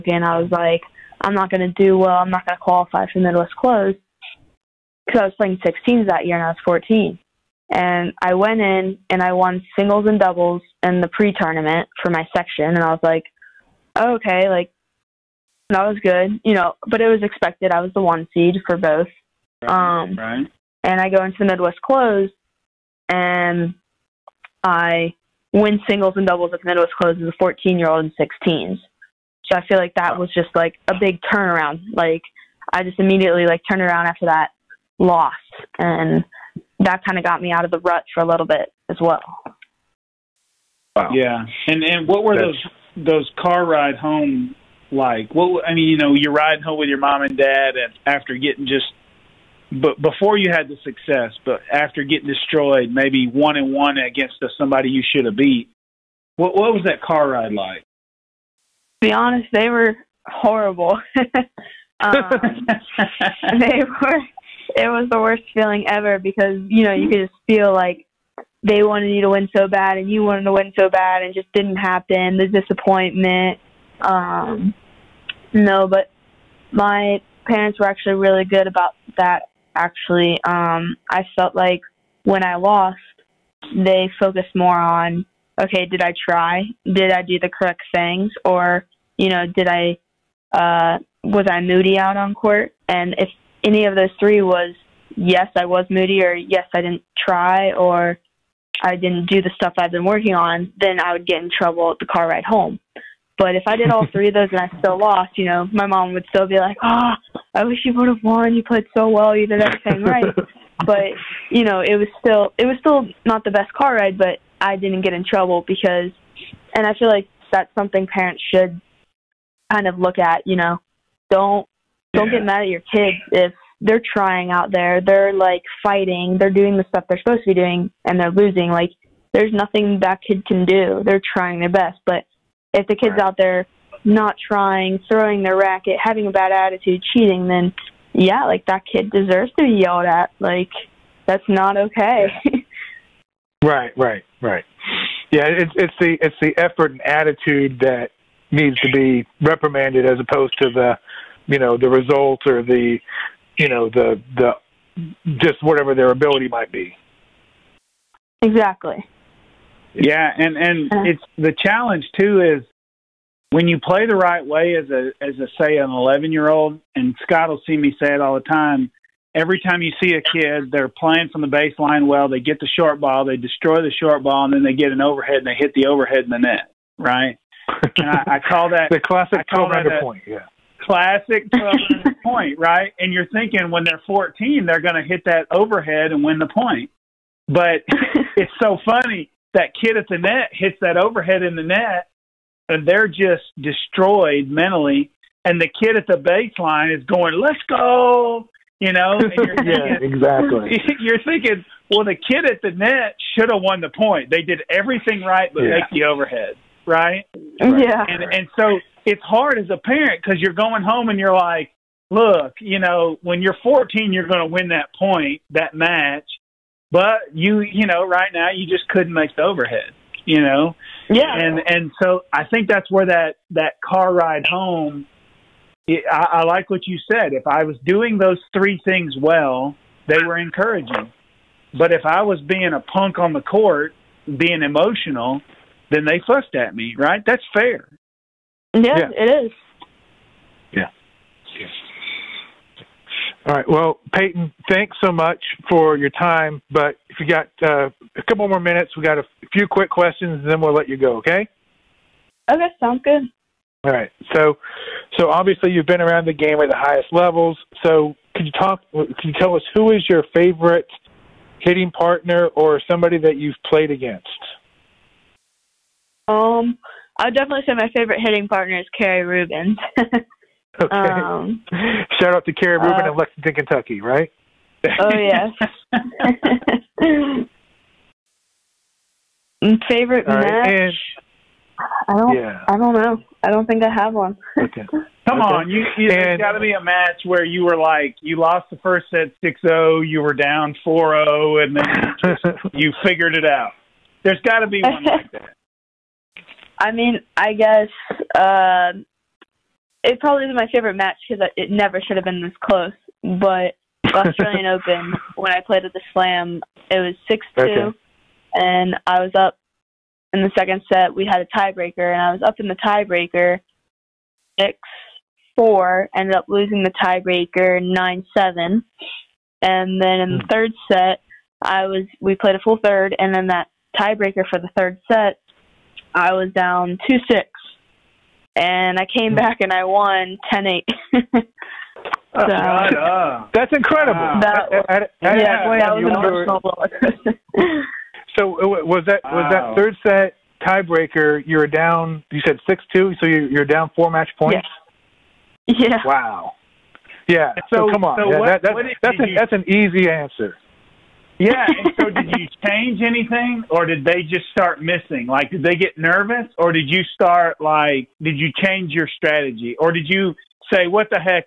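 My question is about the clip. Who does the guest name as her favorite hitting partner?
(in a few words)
Carrie Rubens.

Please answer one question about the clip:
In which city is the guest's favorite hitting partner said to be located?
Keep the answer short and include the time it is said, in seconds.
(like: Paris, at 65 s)
Lexington, at 273 s.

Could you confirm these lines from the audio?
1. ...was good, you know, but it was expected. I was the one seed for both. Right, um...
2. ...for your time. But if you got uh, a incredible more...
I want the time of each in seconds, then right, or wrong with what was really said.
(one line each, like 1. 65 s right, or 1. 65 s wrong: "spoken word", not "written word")
1. 15 s right
2. 245 s wrong: "couple", not "incredible".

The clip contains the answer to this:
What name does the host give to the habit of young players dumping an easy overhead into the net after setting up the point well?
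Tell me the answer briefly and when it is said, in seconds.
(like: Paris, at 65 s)
The classic 12 point, at 178 s.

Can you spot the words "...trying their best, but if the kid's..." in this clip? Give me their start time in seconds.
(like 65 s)
131 s.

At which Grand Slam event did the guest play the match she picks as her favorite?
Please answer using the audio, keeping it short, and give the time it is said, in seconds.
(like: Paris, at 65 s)
Australian Open, at 304 s.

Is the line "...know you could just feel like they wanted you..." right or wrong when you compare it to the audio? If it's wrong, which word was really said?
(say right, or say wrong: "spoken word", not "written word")
right.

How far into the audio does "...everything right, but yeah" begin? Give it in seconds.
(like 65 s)
204 s.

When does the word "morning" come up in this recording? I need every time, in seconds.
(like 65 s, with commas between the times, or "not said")
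not said.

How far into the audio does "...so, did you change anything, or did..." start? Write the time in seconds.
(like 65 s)
351 s.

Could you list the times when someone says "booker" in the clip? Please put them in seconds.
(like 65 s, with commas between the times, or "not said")
not said.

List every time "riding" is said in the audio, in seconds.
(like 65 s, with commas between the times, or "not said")
46 s.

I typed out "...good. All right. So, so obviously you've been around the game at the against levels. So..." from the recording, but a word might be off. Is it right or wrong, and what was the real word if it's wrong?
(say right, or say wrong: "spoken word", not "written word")
wrong: "highest", not "against".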